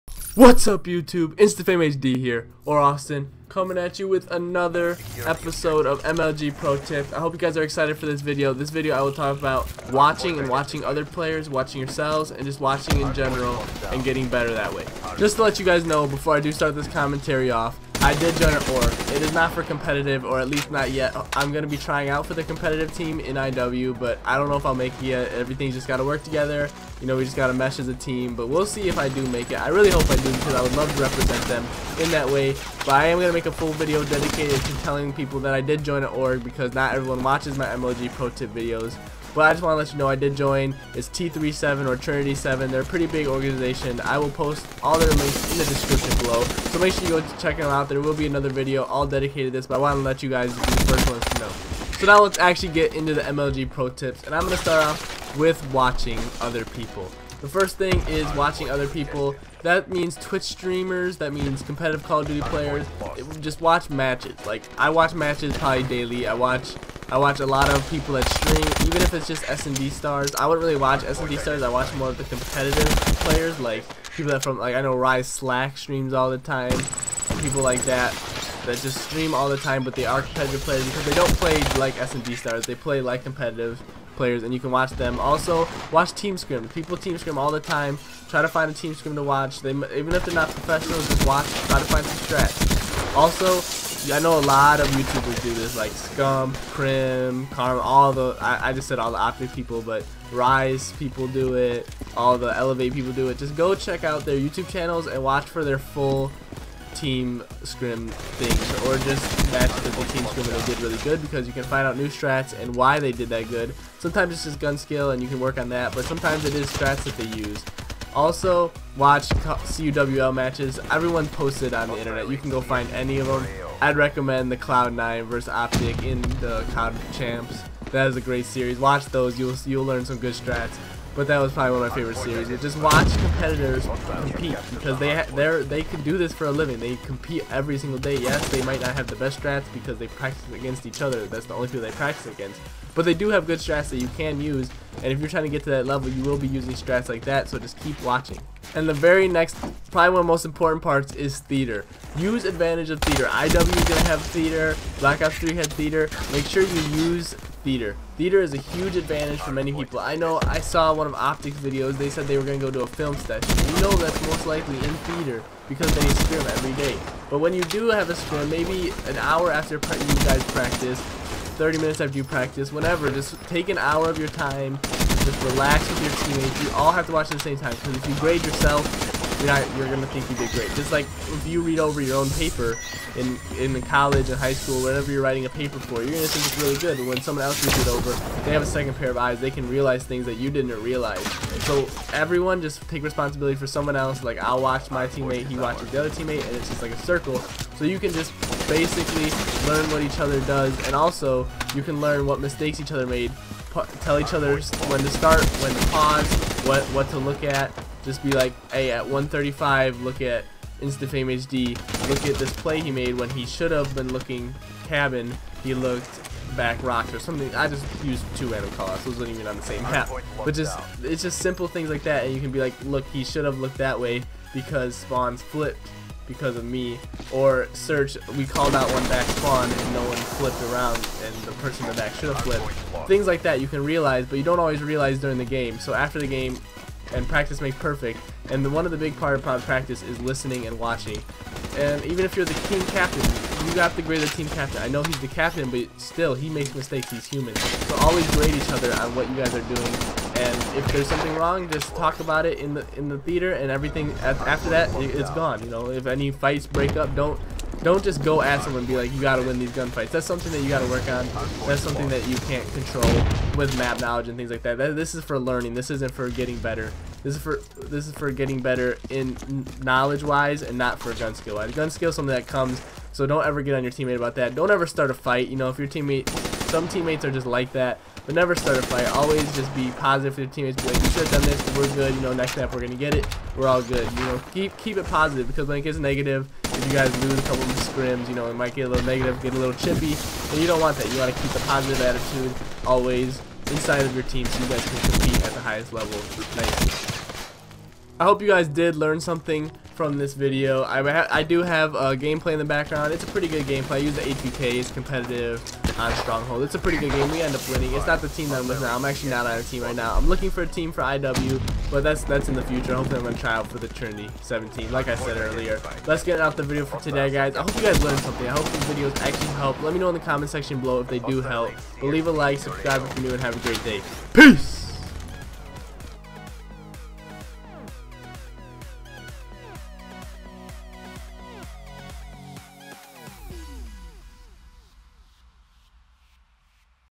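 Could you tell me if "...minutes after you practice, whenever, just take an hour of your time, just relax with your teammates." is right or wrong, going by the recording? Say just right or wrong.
right.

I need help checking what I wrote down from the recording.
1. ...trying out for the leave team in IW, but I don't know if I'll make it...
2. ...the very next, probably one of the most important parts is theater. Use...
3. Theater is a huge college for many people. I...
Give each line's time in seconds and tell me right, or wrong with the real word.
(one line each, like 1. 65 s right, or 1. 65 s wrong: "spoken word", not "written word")
1. 21 s wrong: "competitive", not "leave"
2. 148 s right
3. 158 s wrong: "advantage", not "college".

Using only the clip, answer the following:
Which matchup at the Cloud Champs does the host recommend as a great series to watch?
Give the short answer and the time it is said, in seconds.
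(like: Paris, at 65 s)
Cloud9 versus Optic, at 124 s.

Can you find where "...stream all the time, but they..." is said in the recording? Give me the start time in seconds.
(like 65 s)
79 s.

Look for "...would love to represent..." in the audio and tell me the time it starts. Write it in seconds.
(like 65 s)
30 s.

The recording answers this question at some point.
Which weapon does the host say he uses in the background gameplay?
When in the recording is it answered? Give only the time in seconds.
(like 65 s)
304 s.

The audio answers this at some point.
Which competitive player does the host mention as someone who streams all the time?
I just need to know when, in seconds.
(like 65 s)
74 s.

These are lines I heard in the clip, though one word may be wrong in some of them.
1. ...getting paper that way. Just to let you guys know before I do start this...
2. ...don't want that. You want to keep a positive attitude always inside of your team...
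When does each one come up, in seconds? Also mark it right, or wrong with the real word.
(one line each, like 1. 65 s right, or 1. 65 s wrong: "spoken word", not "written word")
1. 14 s wrong: "better", not "paper"
2. 290 s right.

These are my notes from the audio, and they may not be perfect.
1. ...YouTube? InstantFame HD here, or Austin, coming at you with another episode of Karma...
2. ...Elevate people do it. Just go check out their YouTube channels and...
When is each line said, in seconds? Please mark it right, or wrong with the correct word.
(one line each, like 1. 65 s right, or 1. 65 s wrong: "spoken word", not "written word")
1. 0 s wrong: "MLG", not "Karma"
2. 102 s right.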